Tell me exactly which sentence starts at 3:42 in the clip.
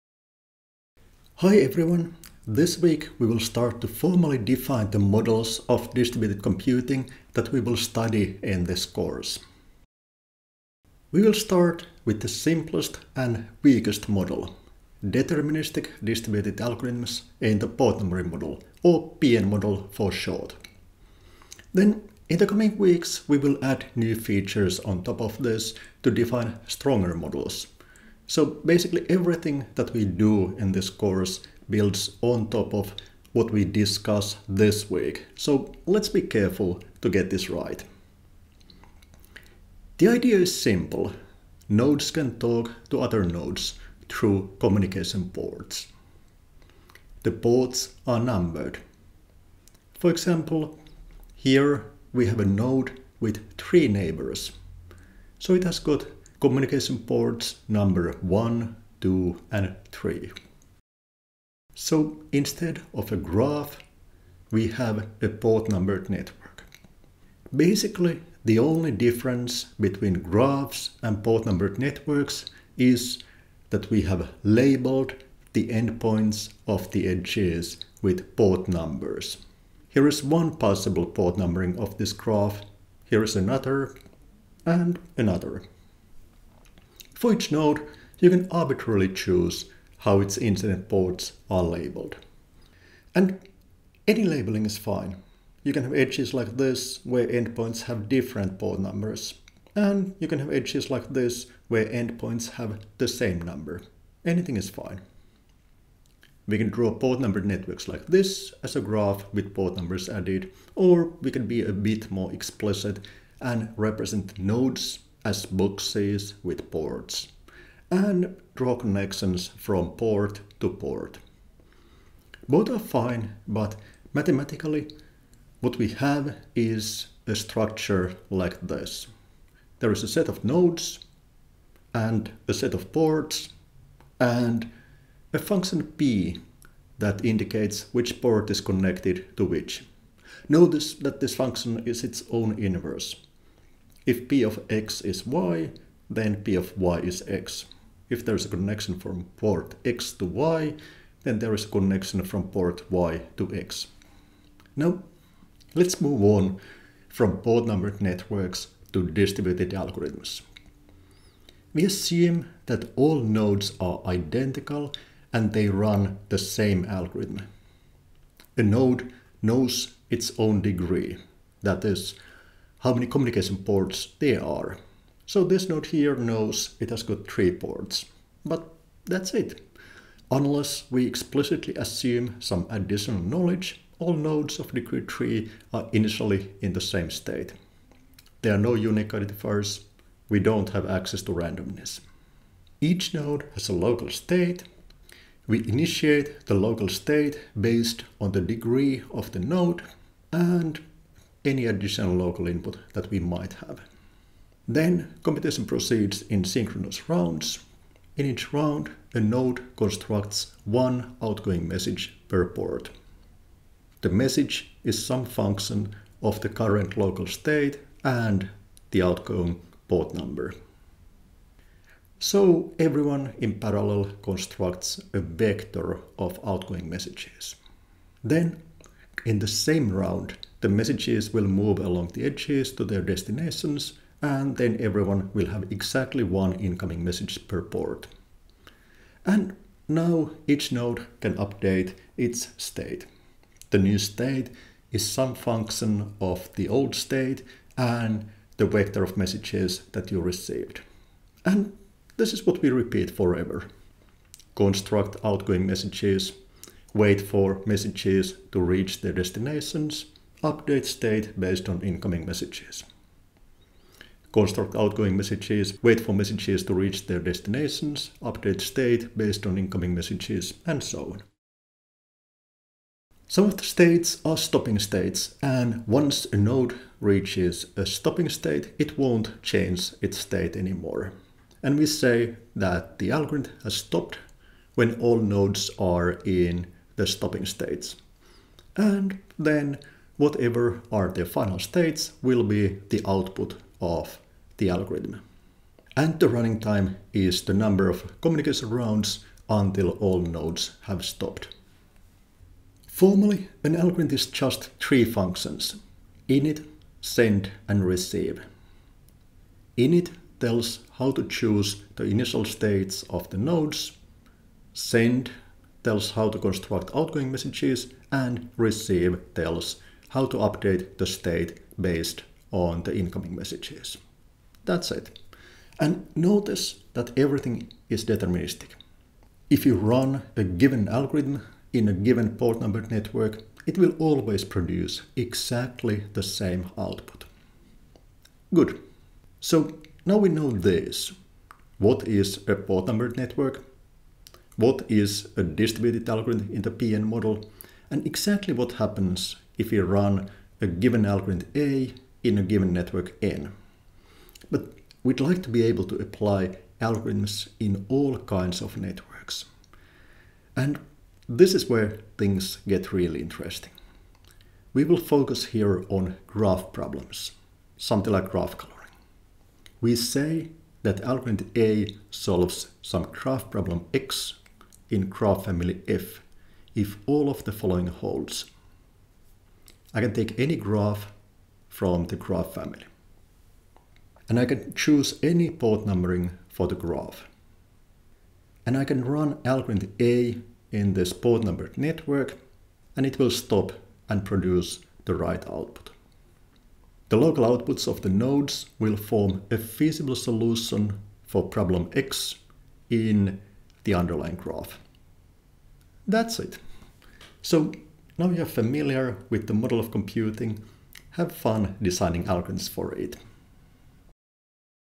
So everyone in parallel constructs a vector of outgoing messages.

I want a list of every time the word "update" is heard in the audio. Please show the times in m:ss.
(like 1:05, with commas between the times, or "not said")
4:01, 4:20, 4:28, 5:20.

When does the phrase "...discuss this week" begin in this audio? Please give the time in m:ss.
0:33.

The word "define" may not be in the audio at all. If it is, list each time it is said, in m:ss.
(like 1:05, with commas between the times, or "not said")
0:04, 0:26.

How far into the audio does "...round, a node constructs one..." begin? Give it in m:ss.
3:28.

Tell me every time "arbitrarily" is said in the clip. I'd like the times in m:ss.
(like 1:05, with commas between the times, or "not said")
1:28.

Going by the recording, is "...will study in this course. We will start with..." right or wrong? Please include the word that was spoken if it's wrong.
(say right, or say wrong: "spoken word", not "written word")
right.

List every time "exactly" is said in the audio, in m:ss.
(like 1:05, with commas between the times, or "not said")
3:55, 5:35, 5:48.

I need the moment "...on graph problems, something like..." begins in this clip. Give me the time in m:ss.
6:05.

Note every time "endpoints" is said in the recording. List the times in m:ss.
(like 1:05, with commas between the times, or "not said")
1:15, 1:37, 1:41.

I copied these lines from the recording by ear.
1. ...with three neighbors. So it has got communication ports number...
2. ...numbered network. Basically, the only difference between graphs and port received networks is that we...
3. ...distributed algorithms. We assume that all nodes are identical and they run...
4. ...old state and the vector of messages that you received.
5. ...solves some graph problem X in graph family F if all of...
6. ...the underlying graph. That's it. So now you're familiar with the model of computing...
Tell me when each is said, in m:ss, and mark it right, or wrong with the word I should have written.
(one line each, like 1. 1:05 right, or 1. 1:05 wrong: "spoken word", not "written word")
1. 0:53 right
2. 1:05 wrong: "numbered", not "received"
3. 2:39 right
4. 4:06 right
5. 6:12 right
6. 6:43 right.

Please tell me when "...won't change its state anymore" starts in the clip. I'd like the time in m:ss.
4:38.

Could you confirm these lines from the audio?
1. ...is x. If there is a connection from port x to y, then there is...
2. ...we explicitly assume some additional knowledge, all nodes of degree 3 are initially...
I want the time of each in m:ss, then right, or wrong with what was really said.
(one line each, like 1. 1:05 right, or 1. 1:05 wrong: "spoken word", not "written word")
1. 2:26 right
2. 3:00 right.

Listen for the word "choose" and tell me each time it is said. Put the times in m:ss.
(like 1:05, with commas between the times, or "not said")
1:29, 5:11, 6:24.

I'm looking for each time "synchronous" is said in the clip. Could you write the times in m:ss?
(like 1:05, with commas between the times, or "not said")
3:26.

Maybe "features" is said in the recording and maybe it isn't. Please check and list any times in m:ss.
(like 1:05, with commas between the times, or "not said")
0:24.